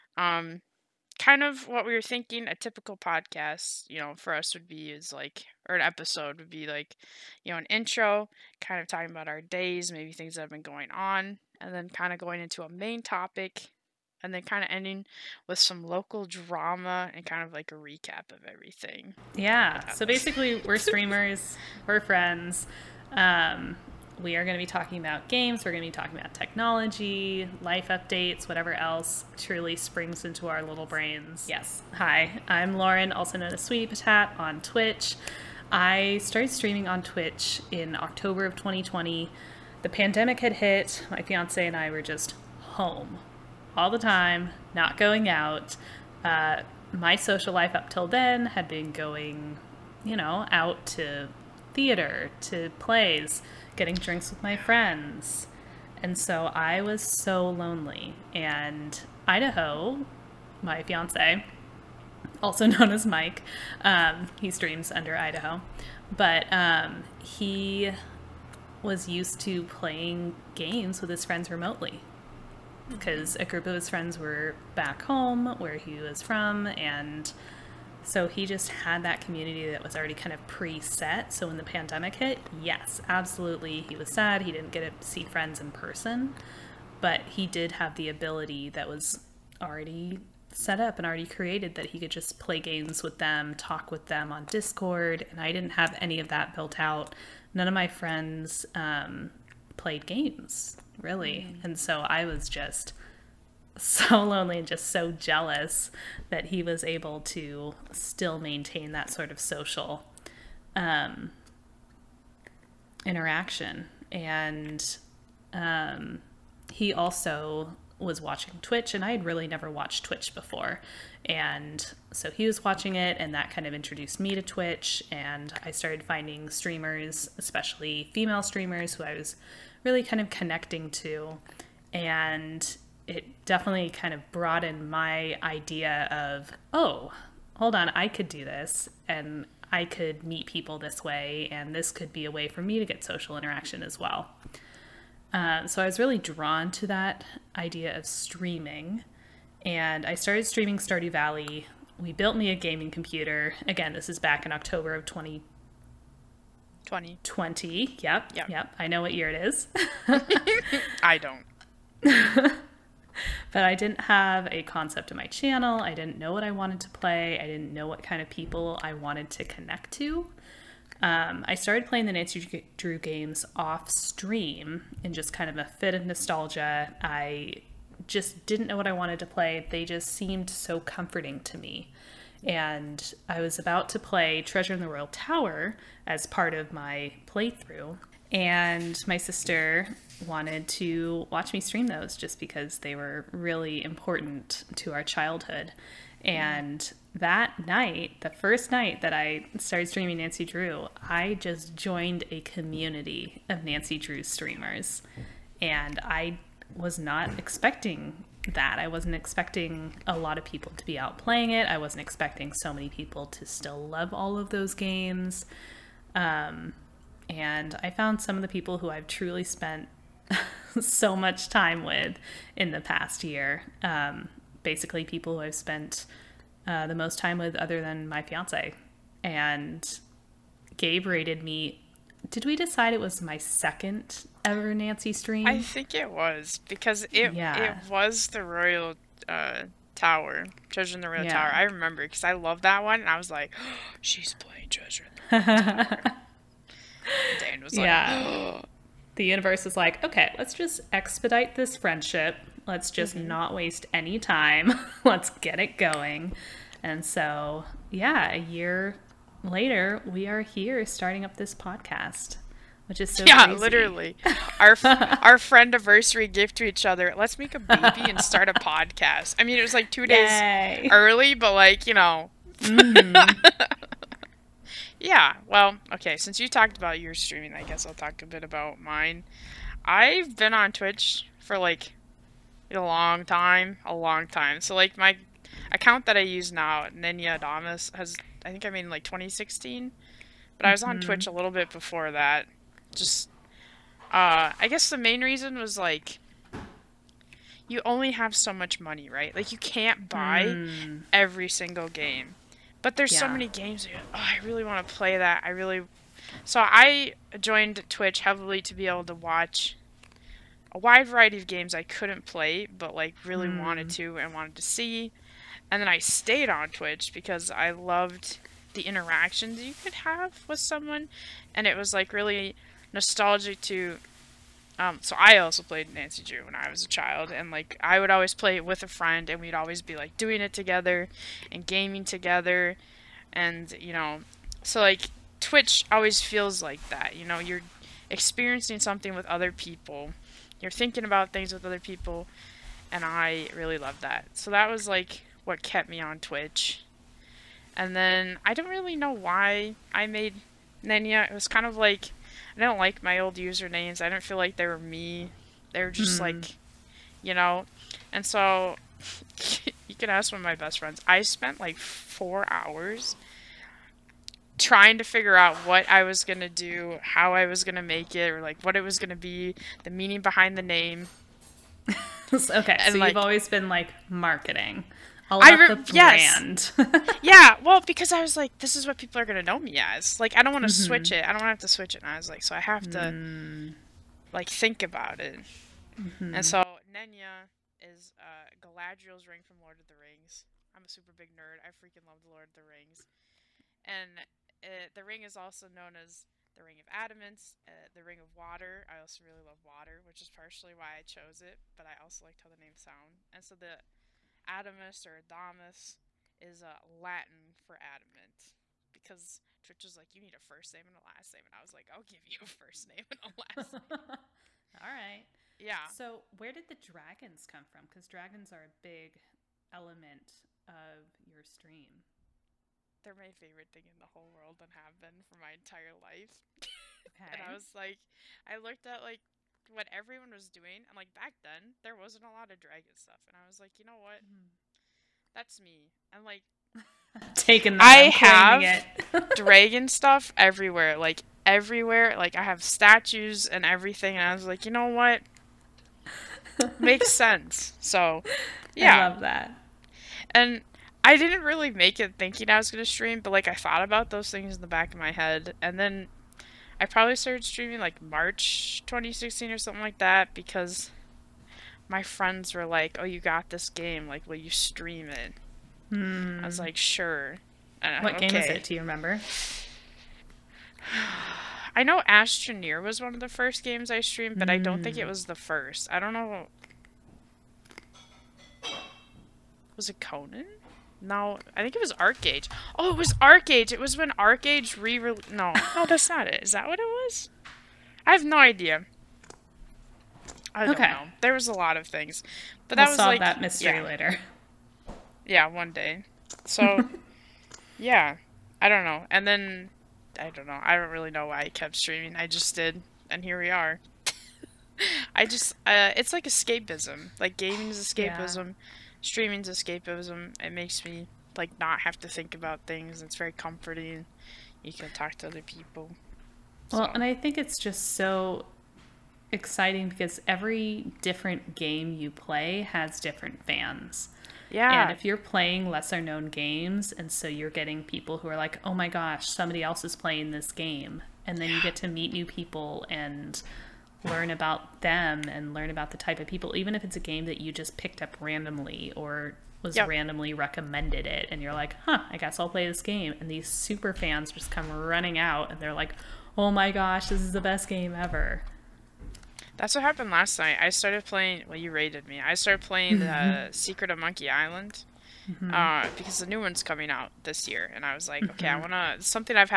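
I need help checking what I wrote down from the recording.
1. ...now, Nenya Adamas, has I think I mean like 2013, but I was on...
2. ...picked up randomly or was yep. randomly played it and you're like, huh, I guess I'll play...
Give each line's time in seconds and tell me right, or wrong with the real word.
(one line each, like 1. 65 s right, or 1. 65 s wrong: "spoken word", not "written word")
1. 286 s wrong: "2016", not "2013"
2. 537 s wrong: "recommended", not "played".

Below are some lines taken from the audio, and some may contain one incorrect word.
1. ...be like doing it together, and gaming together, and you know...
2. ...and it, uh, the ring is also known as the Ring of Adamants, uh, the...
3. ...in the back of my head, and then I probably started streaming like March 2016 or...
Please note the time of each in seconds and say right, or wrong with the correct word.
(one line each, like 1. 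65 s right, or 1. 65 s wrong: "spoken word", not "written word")
1. 329 s right
2. 393 s right
3. 454 s right.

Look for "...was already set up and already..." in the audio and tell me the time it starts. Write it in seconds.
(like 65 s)
88 s.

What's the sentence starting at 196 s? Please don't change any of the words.
And that night, the first night that I started streaming Nancy Drew, I just joined a community of Nancy Drew streamers.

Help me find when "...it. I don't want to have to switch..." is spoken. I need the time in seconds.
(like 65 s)
381 s.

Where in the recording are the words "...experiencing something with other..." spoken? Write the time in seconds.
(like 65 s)
338 s.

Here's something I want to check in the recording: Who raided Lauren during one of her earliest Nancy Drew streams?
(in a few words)
Gabe.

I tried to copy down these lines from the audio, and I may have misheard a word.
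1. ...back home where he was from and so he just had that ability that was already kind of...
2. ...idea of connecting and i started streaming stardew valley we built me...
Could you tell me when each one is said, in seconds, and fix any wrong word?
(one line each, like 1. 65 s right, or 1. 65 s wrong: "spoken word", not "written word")
1. 74 s wrong: "community", not "ability"
2. 147 s wrong: "streaming", not "connecting".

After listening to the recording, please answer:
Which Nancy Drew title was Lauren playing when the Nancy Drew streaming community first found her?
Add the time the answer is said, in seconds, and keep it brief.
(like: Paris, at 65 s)
Treasure in the Royal Tower, at 184 s.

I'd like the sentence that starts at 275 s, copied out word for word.
Yeah, well, okay, since you talked about your streaming, I guess I'll talk a bit about mine.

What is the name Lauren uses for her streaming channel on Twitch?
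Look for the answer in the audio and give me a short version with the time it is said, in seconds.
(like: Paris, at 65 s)
Sweetie Potat, at 33 s.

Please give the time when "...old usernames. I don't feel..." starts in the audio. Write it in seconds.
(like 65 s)
353 s.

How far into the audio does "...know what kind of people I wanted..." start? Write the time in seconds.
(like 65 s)
167 s.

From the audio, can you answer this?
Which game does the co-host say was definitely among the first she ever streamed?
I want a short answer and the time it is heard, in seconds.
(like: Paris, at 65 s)
Astroneer, at 472 s.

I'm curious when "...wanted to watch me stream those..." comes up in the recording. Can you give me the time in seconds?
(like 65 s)
190 s.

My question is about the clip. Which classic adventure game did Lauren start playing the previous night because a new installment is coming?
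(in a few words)
Secret of Monkey Island.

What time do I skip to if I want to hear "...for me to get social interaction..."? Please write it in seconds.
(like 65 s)
142 s.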